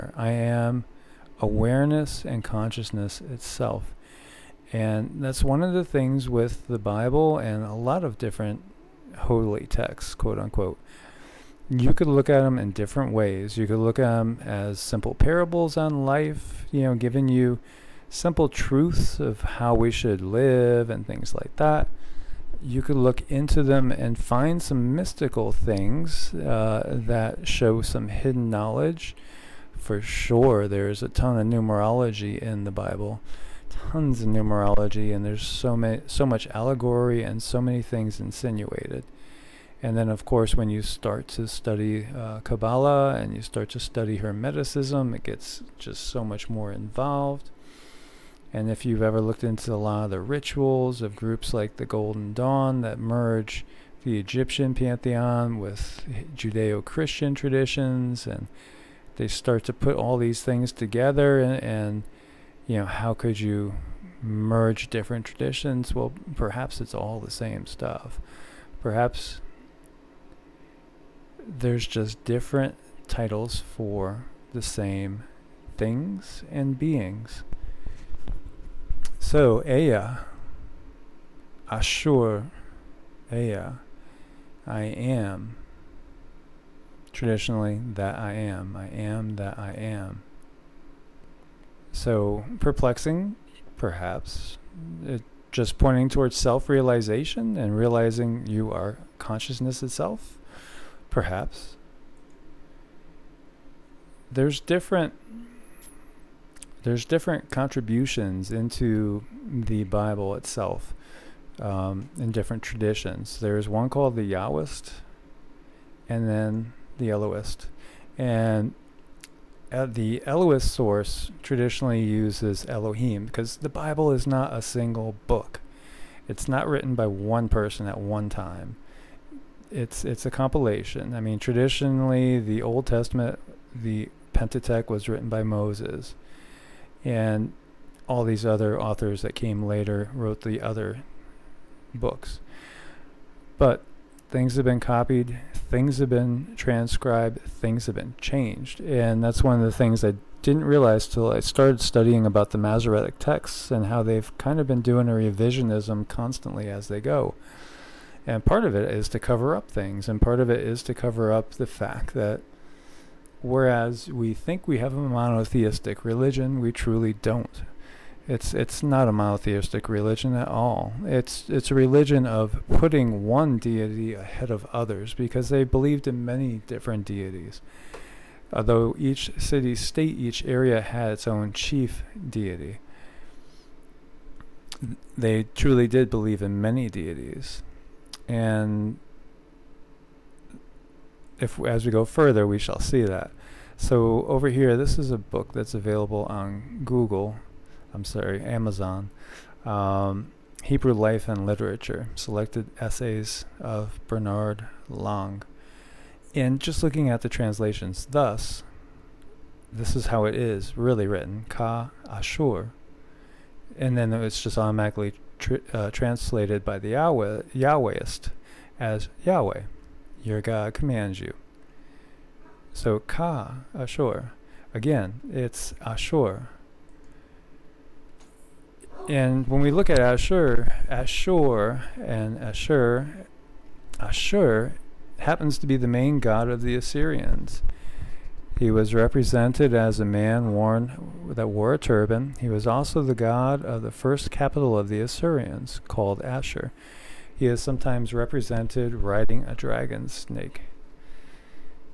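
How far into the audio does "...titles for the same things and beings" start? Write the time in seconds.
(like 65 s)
73 s.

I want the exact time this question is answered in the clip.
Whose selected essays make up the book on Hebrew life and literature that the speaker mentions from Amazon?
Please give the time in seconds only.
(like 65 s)
204 s.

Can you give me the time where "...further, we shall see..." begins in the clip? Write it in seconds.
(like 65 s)
192 s.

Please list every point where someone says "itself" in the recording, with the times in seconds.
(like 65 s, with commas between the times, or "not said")
3 s, 99 s, 110 s.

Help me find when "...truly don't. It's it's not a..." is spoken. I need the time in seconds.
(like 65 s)
166 s.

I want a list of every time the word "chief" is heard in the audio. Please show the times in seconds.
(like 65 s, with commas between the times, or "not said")
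181 s.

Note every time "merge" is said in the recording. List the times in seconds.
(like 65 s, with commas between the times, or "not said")
52 s, 64 s.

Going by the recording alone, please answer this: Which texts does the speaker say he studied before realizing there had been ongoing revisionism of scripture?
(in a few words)
Masoretic texts.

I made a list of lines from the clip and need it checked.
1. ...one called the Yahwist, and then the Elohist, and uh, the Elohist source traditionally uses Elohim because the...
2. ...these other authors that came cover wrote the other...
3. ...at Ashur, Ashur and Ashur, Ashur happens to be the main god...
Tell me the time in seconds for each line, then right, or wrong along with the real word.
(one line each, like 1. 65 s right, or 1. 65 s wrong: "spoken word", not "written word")
1. 113 s right
2. 138 s wrong: "later", not "cover"
3. 229 s right.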